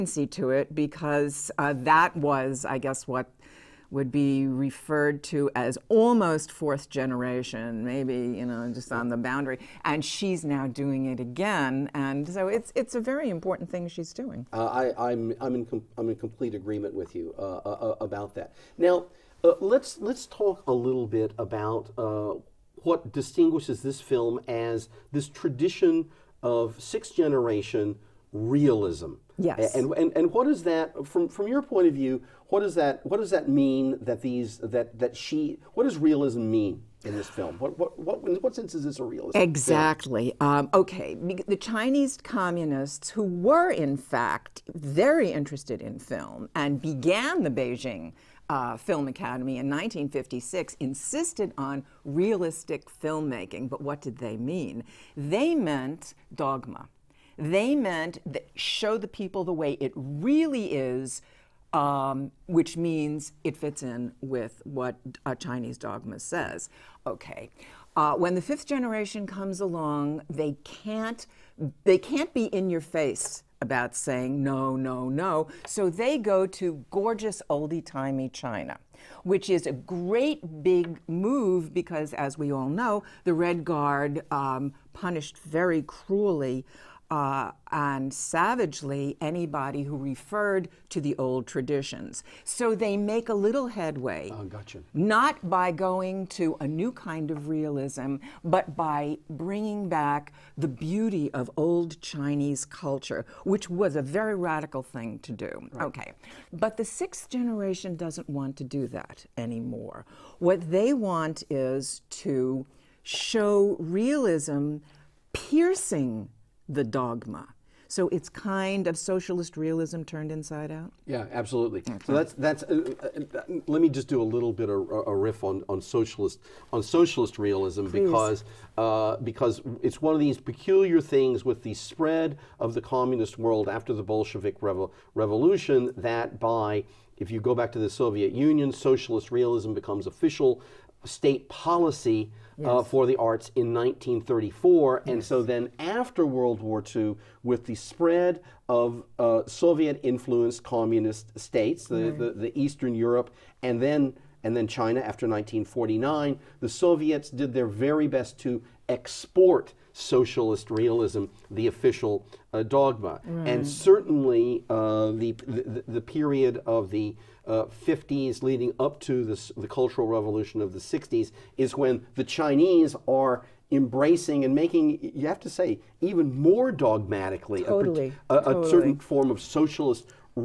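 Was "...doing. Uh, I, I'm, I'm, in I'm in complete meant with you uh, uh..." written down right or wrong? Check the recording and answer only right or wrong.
wrong.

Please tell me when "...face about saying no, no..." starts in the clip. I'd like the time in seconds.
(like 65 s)
72 s.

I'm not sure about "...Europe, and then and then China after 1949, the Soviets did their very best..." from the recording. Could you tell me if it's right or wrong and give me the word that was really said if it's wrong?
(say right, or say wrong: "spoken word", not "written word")
right.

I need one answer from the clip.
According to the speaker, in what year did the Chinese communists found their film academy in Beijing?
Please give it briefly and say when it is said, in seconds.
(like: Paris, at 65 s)
1956, at 49 s.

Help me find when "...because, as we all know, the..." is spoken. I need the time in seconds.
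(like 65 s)
81 s.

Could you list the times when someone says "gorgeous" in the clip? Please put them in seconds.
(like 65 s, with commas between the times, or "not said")
76 s.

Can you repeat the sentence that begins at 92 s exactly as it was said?
So they make a little headway.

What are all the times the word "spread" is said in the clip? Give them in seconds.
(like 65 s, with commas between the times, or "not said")
131 s, 147 s.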